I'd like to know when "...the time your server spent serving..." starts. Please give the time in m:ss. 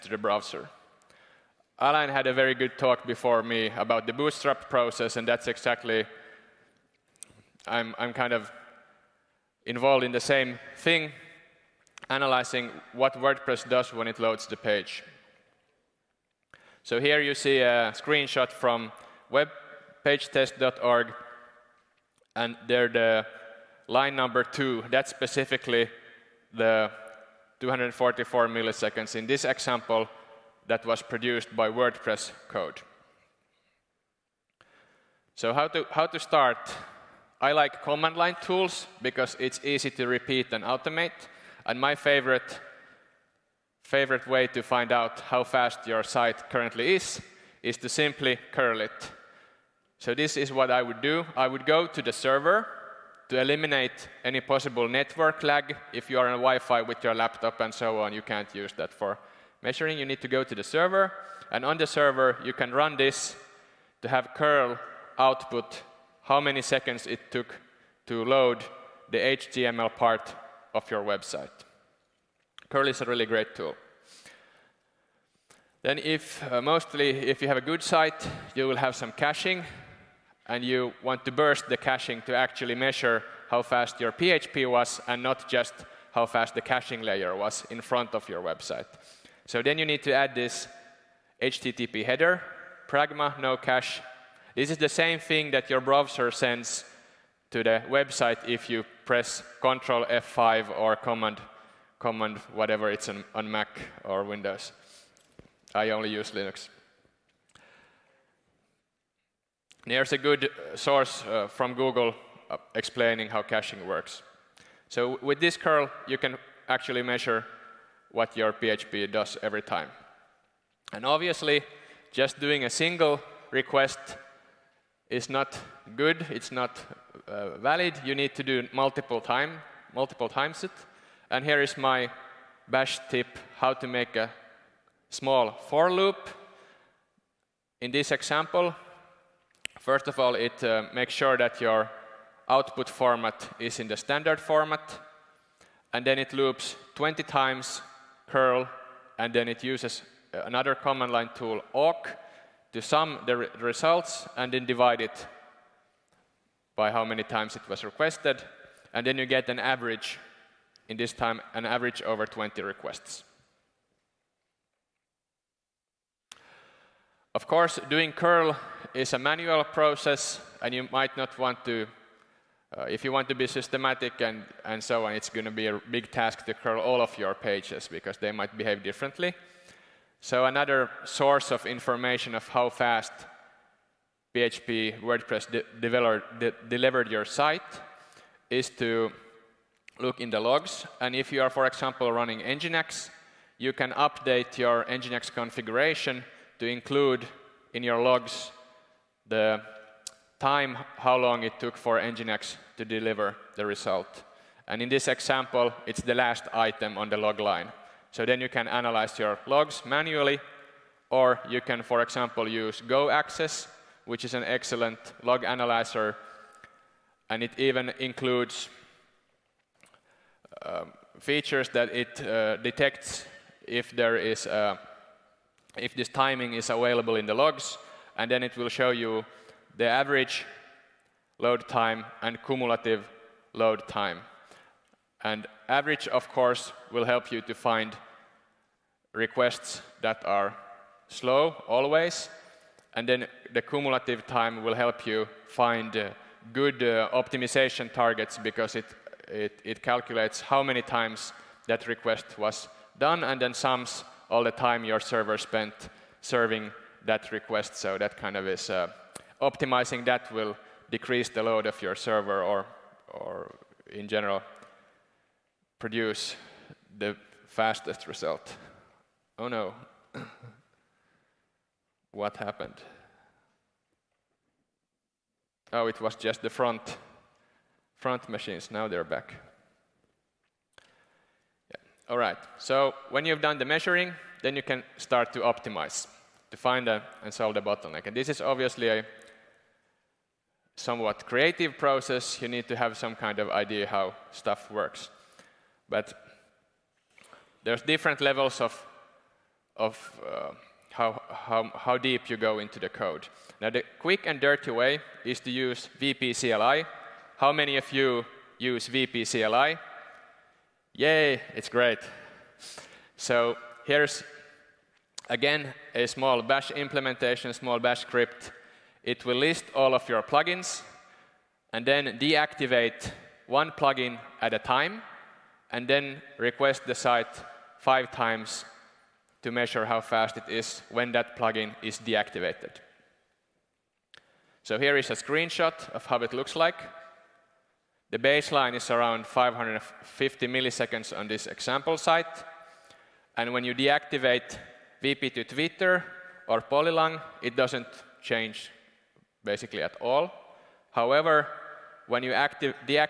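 4:14.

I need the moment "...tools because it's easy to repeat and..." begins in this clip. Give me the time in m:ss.
0:38.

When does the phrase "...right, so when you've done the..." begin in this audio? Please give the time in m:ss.
4:42.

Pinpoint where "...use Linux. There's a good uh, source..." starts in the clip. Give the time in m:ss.
1:46.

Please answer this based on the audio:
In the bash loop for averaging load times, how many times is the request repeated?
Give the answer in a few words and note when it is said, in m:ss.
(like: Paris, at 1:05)
20, at 2:26.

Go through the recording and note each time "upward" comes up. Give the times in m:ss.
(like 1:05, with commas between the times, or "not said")
not said.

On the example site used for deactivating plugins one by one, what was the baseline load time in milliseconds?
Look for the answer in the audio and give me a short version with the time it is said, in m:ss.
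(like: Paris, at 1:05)
550, at 5:39.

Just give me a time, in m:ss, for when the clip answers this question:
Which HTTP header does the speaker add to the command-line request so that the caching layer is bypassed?
1:32.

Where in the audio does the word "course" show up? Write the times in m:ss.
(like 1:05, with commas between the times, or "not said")
2:47, 3:56.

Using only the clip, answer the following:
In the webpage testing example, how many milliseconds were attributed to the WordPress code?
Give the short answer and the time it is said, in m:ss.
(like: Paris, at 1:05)
244, at 0:27.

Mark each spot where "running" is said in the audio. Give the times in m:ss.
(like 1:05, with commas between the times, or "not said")
3:12.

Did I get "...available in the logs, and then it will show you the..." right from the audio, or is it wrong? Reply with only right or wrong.
right.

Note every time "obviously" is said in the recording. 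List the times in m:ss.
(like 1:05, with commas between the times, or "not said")
2:01, 4:48.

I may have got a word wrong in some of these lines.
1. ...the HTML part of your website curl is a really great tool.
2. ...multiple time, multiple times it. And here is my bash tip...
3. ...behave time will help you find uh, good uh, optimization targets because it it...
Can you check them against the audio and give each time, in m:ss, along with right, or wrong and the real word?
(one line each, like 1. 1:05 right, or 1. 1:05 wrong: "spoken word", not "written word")
1. 1:09 right
2. 2:08 right
3. 4:03 wrong: "cumulative", not "behave".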